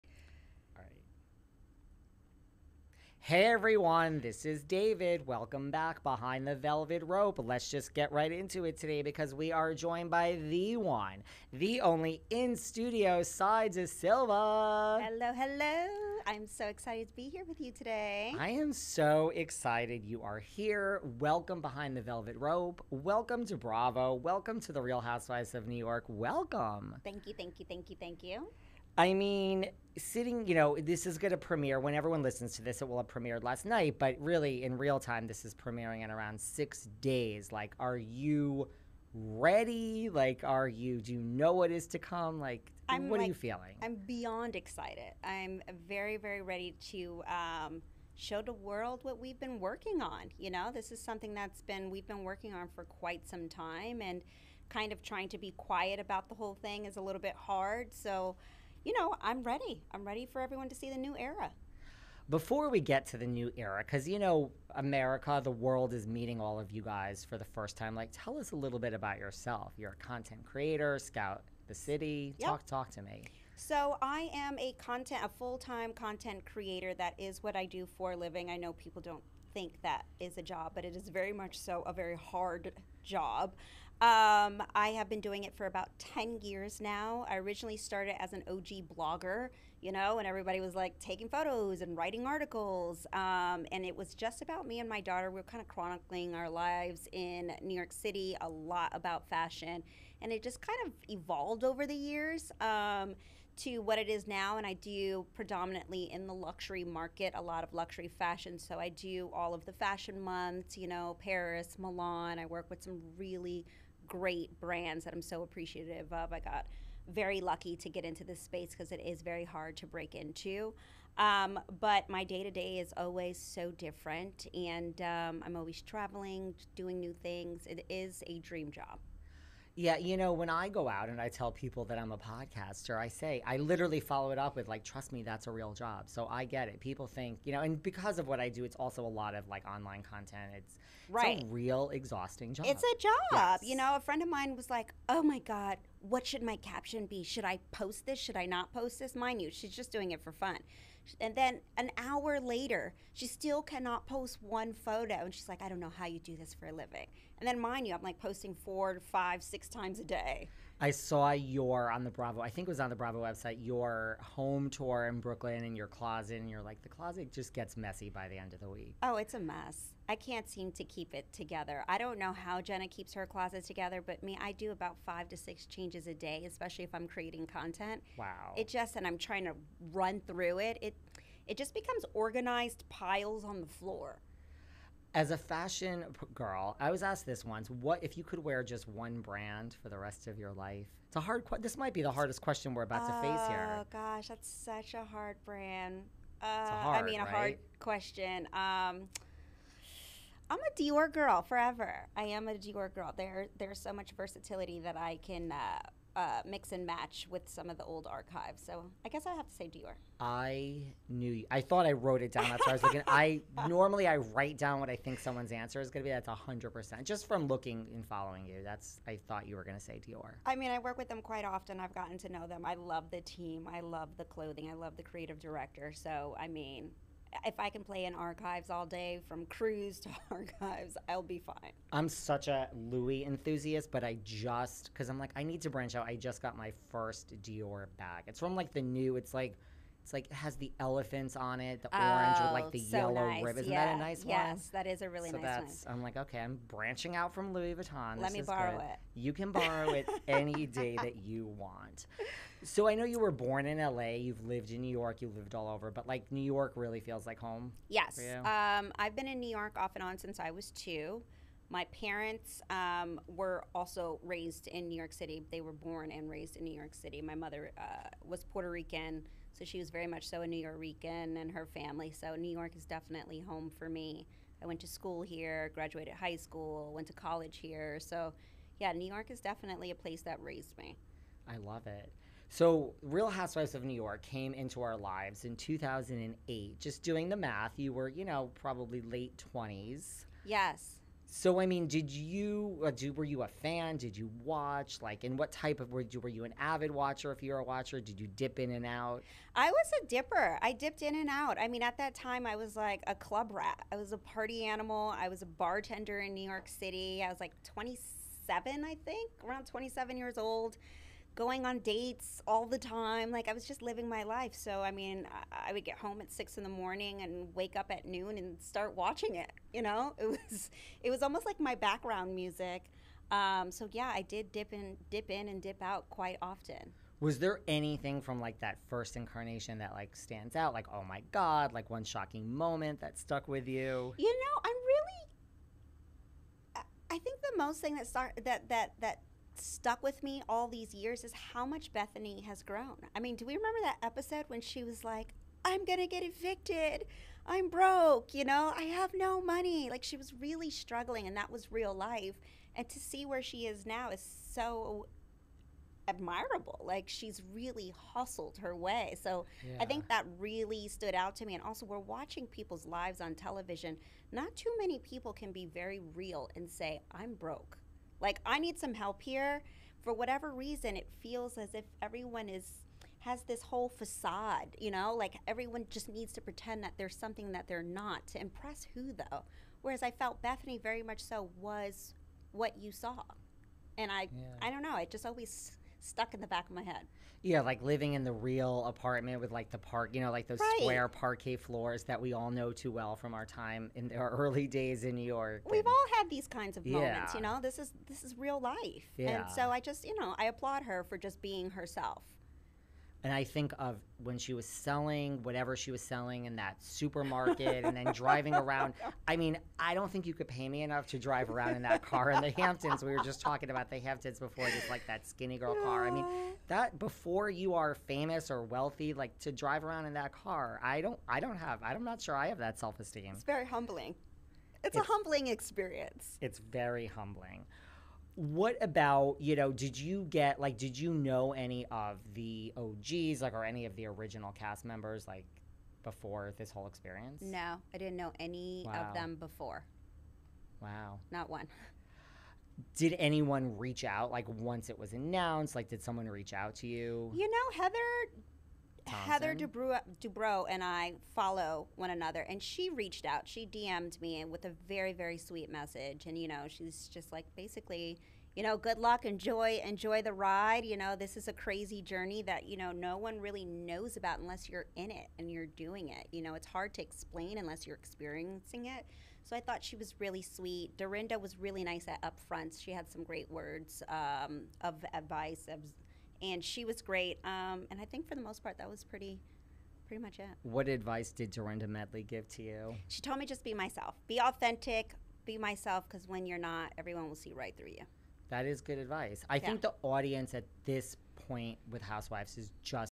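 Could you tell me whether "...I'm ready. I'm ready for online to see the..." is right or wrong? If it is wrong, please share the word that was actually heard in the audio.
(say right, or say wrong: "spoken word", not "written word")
wrong: "everyone", not "online".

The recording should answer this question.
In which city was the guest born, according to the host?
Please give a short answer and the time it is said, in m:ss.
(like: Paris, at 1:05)
LA, at 4:13.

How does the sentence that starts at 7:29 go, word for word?
Heather Dubrow, Dubrow and I follow one another, and she reached out.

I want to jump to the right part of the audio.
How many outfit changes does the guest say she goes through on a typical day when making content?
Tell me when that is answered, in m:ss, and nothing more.
2:54.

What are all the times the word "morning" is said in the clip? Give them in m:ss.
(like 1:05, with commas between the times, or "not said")
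5:16.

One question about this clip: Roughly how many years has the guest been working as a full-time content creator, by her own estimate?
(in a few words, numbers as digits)
10 years.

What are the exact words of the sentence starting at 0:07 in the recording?
Let's just get right into it today because we are joined by the one, the only in studio Sai De Silva.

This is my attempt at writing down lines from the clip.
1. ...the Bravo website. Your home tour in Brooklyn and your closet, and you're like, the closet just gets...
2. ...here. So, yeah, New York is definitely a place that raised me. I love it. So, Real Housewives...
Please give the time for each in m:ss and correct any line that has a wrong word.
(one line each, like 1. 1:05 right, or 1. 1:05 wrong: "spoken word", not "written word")
1. 2:42 right
2. 4:37 right.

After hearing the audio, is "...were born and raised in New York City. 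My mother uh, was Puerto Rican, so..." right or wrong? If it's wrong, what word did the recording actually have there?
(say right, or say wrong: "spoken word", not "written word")
right.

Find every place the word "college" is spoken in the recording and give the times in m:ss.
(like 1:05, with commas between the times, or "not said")
4:37.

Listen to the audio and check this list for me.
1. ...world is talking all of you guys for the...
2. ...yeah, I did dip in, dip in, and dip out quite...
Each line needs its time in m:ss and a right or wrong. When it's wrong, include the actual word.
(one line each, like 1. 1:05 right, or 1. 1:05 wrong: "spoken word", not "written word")
1. 1:05 wrong: "meeting", not "talking"
2. 5:23 right.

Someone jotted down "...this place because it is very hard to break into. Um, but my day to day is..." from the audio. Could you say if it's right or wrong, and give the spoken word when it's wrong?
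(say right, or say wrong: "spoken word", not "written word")
wrong: "space", not "place".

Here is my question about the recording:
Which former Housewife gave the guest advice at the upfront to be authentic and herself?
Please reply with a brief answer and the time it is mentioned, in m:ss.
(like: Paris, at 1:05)
Dorinda Medley, at 8:01.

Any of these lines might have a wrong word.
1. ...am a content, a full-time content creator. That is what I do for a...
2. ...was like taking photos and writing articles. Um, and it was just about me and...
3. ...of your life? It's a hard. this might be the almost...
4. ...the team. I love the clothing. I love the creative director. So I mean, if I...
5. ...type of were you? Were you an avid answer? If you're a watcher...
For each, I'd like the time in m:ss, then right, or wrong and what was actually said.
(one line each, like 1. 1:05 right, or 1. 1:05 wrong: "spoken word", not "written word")
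1. 1:14 right
2. 1:30 right
3. 3:10 wrong: "hardest", not "almost"
4. 3:43 right
5. 4:55 wrong: "watcher", not "answer".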